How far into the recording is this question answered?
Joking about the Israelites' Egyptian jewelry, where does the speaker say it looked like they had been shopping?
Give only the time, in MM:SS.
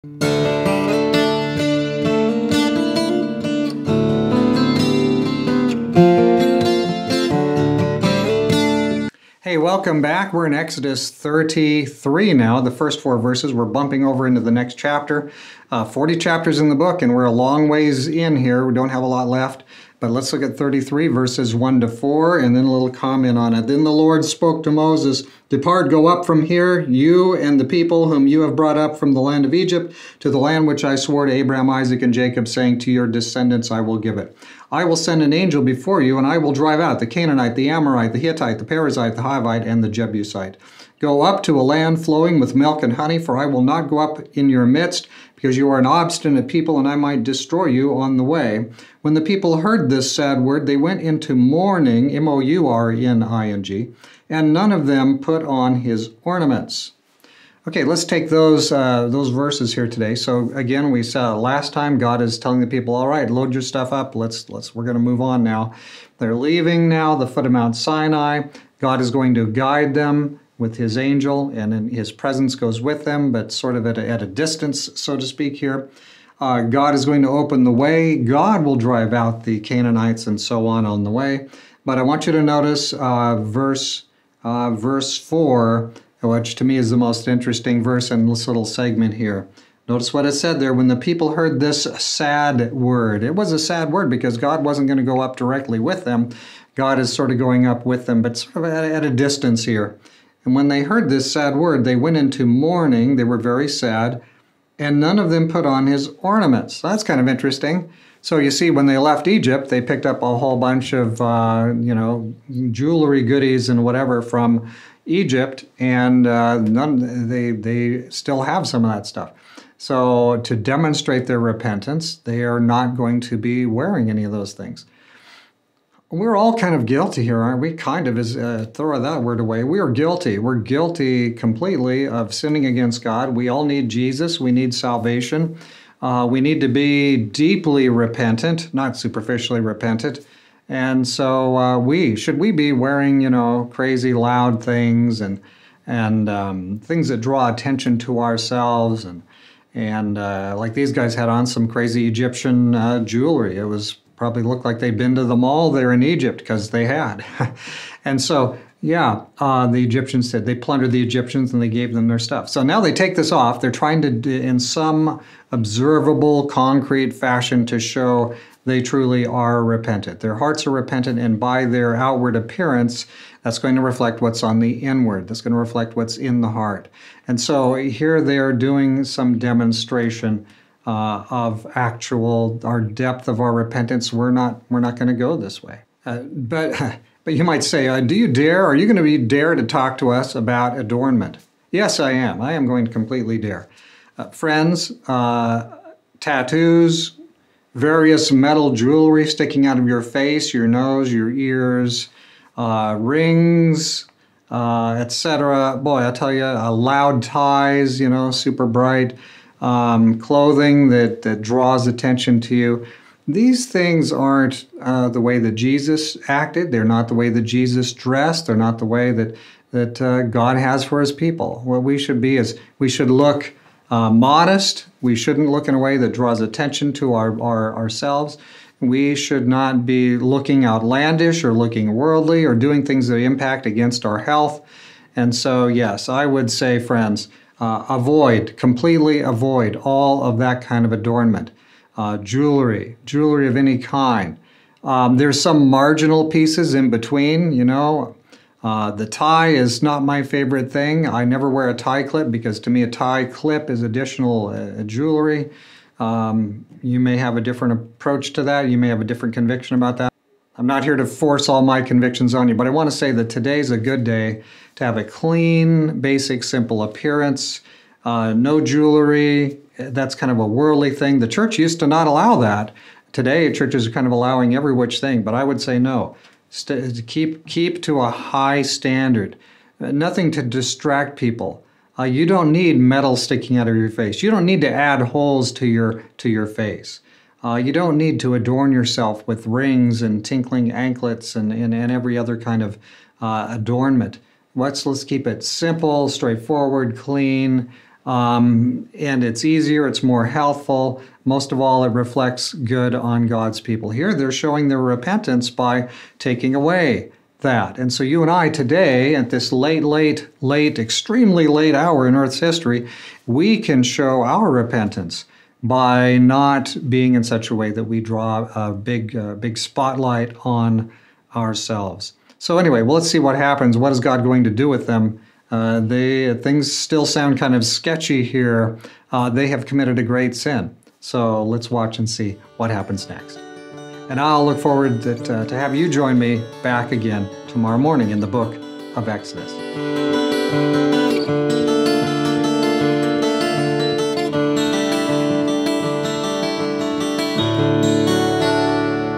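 02:35.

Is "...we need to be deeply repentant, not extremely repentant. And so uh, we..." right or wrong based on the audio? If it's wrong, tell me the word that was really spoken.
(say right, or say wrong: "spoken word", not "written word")
wrong: "superficially", not "extremely".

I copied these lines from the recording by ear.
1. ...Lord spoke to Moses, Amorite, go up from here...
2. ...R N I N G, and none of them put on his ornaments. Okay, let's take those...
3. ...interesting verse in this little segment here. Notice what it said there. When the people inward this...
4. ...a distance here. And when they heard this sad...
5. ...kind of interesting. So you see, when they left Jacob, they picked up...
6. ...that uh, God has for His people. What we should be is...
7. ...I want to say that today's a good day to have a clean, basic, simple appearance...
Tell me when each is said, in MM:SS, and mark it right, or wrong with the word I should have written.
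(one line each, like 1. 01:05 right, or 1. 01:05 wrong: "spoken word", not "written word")
1. 00:23 wrong: "Depart", not "Amorite"
2. 00:52 right
3. 01:27 wrong: "heard", not "inward"
4. 01:39 right
5. 01:47 wrong: "Egypt", not "Jacob"
6. 03:39 right
7. 04:22 right.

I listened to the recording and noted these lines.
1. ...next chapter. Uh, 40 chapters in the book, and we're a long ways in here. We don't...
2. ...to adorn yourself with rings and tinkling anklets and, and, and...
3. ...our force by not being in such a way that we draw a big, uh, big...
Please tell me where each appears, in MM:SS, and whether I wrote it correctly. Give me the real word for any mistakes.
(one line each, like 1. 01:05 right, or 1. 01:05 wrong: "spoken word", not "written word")
1. 00:14 right
2. 04:48 right
3. 05:14 wrong: "repentance", not "force".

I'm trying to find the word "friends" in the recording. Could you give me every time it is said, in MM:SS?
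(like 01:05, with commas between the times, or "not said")
03:14, 03:56.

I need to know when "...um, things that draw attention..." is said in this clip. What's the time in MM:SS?
02:26.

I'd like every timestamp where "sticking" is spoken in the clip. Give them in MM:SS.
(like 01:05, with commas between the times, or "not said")
03:19, 04:43.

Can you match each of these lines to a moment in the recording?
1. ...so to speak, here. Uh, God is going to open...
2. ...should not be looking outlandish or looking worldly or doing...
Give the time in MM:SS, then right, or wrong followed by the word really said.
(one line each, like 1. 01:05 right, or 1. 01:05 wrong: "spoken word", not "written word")
1. 01:14 right
2. 03:49 right.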